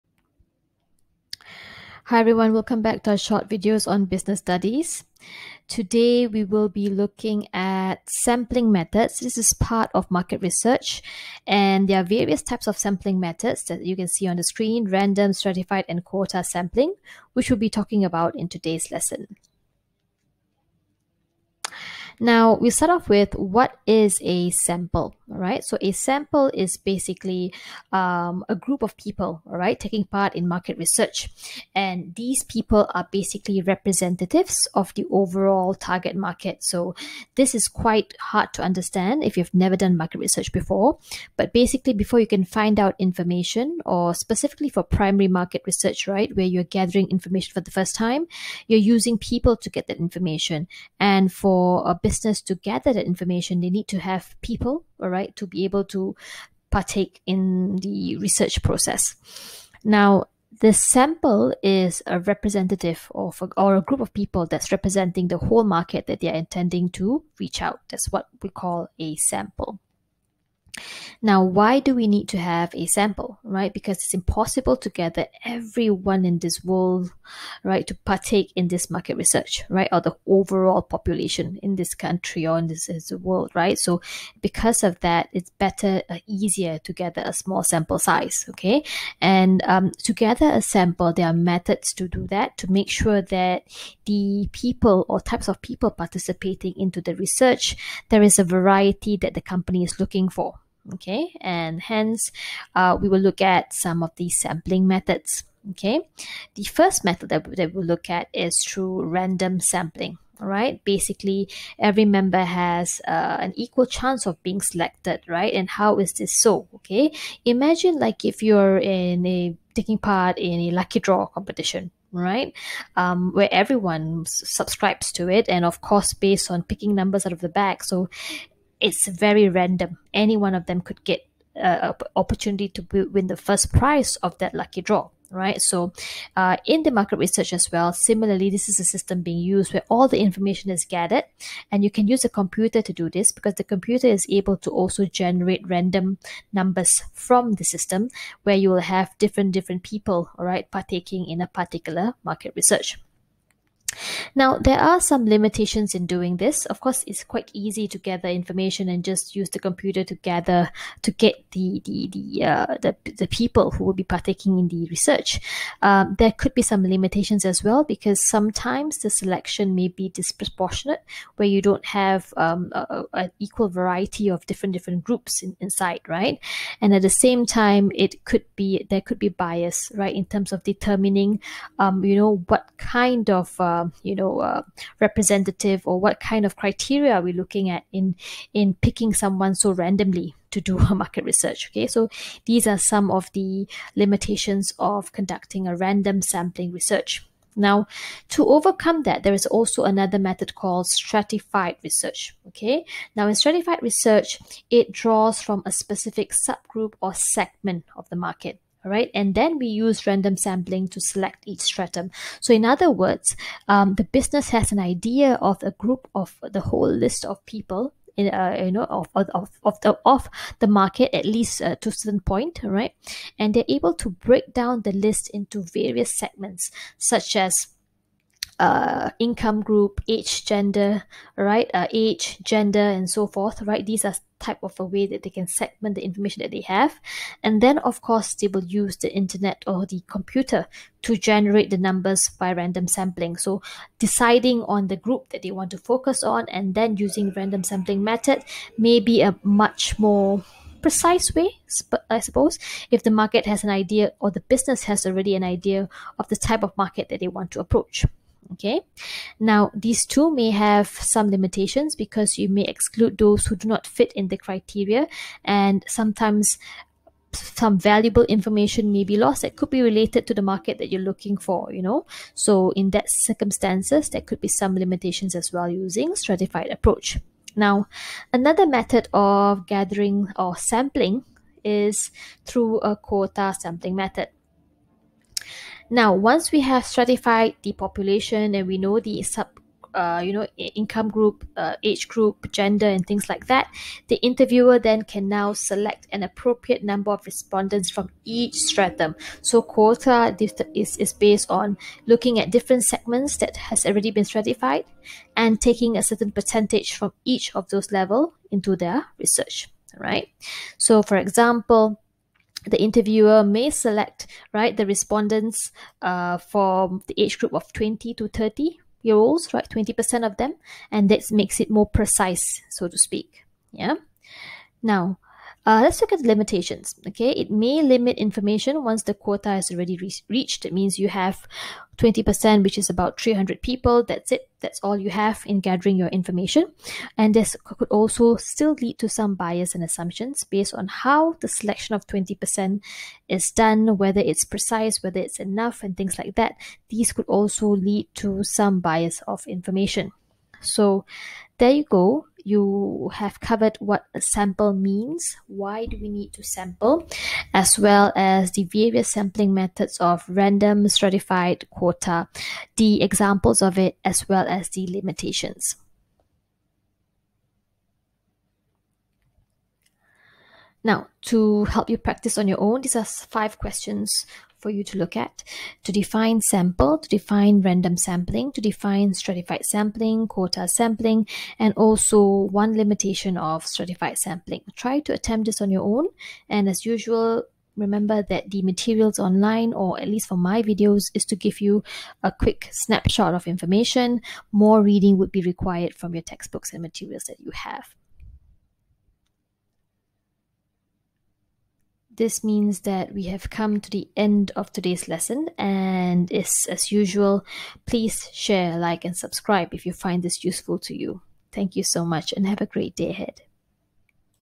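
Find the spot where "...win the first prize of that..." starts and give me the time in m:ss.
2:13.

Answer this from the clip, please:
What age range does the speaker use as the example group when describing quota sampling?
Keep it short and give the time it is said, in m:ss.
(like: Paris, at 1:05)
20 to 30, at 5:17.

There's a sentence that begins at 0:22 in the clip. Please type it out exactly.
Now we start off with what is a sample, right?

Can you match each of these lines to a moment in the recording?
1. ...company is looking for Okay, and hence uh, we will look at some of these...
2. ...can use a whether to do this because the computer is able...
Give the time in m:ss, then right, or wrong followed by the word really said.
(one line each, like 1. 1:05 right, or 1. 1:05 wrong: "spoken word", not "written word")
1. 1:39 right
2. 2:21 wrong: "computer", not "whether".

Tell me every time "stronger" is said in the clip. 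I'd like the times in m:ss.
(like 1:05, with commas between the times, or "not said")
not said.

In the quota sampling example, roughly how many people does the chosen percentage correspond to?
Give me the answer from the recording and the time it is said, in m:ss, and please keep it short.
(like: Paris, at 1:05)
300, at 5:33.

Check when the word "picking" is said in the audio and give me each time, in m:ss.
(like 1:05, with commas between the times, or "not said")
2:06, 3:08.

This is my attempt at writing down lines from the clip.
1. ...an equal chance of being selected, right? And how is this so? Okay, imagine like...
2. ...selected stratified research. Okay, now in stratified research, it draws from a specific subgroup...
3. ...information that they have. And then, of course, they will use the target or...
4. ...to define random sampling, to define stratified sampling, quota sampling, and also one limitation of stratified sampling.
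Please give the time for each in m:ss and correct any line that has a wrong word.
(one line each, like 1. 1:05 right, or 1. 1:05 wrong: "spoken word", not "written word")
1. 1:53 right
2. 3:20 wrong: "called", not "selected"
3. 3:56 wrong: "internet", not "target"
4. 6:16 right.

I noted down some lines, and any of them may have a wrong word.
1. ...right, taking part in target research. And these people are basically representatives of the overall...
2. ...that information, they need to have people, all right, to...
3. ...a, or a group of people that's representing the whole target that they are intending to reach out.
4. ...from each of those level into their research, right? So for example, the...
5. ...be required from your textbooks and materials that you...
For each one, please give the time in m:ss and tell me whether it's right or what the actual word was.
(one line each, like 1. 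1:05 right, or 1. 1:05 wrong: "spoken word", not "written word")
1. 0:29 wrong: "market", not "target"
2. 0:52 right
3. 1:03 wrong: "market", not "target"
4. 5:06 right
5. 6:35 right.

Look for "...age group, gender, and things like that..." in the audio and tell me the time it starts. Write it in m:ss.
4:51.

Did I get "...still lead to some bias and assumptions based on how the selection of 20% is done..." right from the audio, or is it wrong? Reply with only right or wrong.
right.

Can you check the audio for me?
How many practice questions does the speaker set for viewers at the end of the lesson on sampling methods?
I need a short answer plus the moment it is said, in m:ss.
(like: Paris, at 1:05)
5, at 6:13.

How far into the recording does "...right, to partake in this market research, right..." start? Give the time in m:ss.
1:17.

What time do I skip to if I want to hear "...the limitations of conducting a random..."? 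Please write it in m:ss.
3:13.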